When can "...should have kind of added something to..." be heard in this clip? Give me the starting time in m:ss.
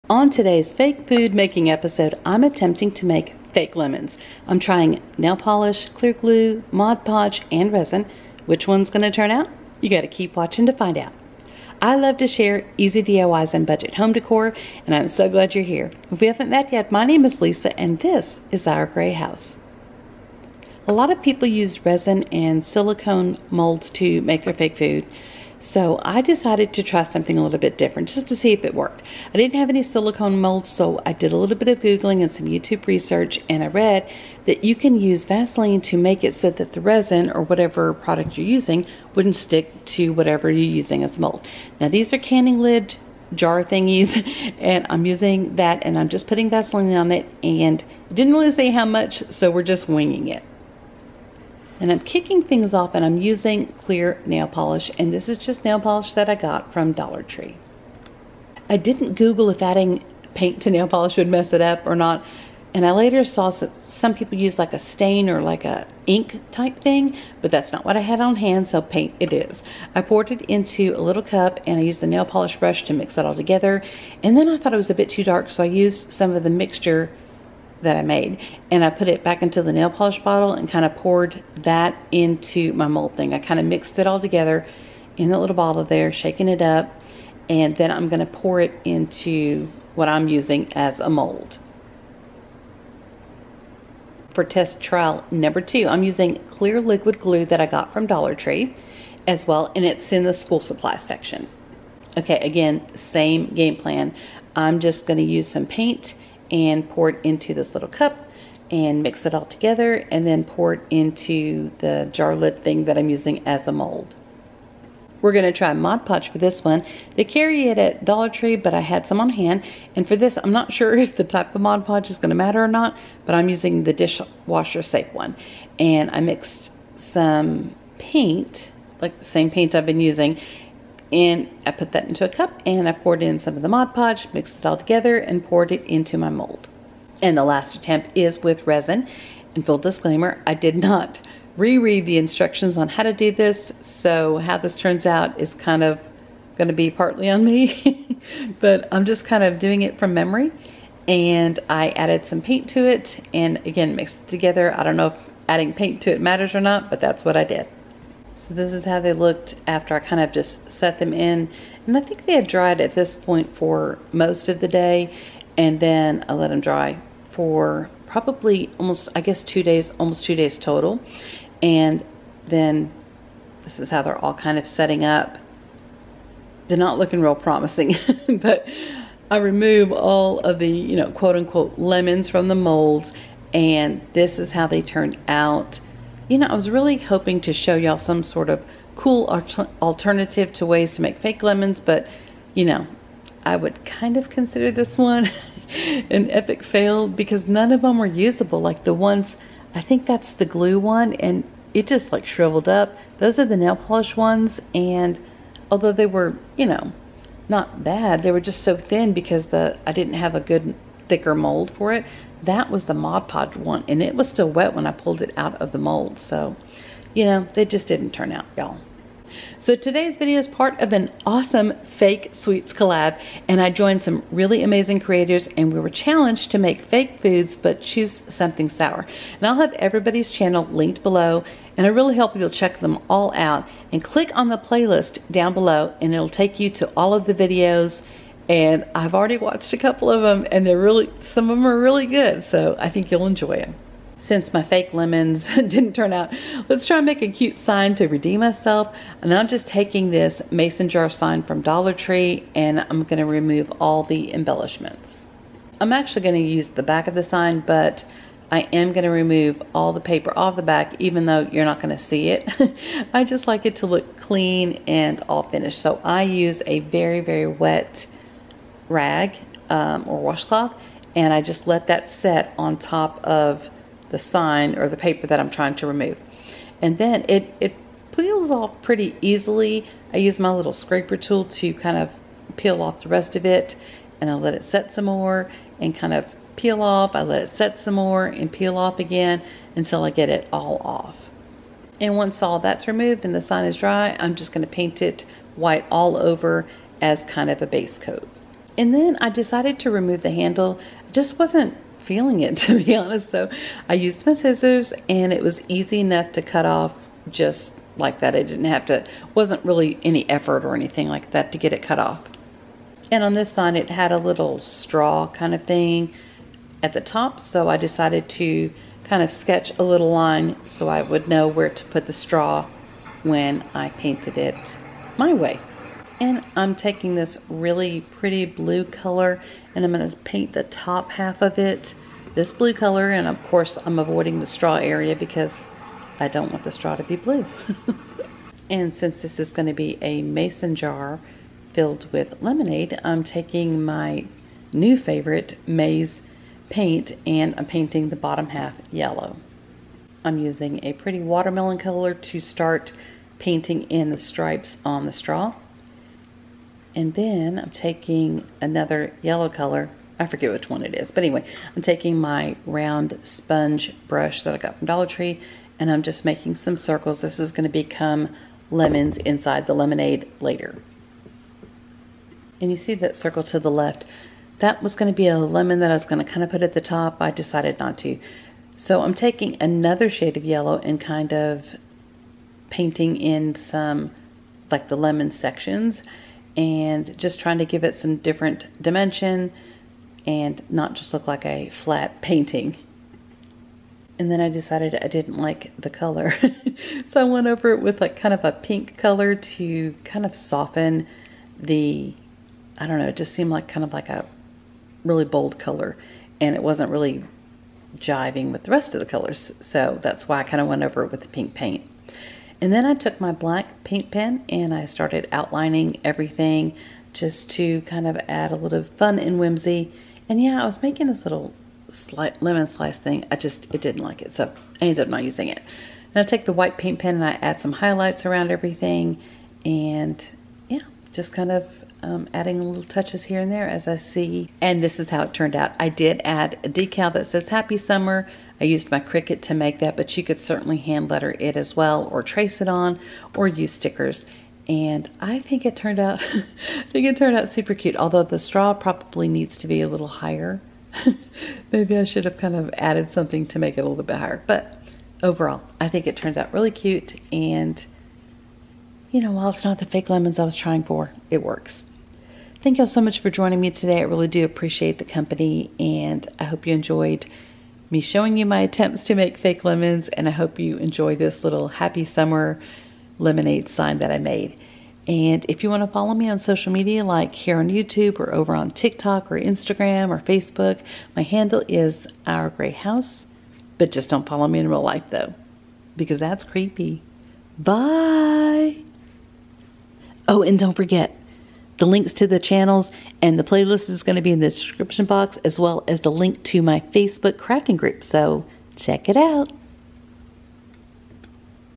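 7:32.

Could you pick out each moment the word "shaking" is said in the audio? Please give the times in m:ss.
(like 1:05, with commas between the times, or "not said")
1:26.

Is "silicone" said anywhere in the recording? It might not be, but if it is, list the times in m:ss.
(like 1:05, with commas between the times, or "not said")
0:22, 0:29.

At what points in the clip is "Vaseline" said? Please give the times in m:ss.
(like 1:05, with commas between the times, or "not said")
0:35, 0:46.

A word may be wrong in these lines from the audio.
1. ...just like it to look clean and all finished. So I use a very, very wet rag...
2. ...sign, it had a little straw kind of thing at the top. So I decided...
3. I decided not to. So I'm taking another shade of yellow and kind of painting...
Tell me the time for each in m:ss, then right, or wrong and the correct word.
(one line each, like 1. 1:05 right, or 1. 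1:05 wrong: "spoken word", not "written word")
1. 4:23 right
2. 5:13 right
3. 6:17 right.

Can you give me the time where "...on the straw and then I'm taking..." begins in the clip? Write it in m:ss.
5:54.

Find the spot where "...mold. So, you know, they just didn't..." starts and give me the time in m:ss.
3:35.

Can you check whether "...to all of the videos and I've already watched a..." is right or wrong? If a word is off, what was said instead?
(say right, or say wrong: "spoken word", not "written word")
right.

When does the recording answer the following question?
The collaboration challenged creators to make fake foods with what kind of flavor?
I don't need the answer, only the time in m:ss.
3:48.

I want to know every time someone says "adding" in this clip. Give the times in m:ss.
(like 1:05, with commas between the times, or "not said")
0:59, 2:35, 7:12.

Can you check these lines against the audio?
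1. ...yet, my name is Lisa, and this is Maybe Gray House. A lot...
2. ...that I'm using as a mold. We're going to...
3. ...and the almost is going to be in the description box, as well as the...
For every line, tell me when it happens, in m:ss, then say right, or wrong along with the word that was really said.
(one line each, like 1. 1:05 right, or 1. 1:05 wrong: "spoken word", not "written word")
1. 0:16 wrong: "Our", not "Maybe"
2. 1:52 right
3. 8:13 wrong: "playlist", not "almost".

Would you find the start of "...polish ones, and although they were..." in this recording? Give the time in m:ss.
3:23.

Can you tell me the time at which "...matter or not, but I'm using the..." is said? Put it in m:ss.
2:02.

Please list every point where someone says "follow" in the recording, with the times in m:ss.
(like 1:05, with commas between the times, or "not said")
7:55, 8:04.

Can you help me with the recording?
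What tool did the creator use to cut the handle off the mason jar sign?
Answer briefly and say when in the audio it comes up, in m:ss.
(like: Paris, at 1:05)
scissors, at 5:04.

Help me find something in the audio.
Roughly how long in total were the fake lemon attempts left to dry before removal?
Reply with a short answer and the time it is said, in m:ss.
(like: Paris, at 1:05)
almost 2 days, at 2:49.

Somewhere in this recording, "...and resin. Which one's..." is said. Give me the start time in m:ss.
0:07.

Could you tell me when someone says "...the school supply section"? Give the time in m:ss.
1:40.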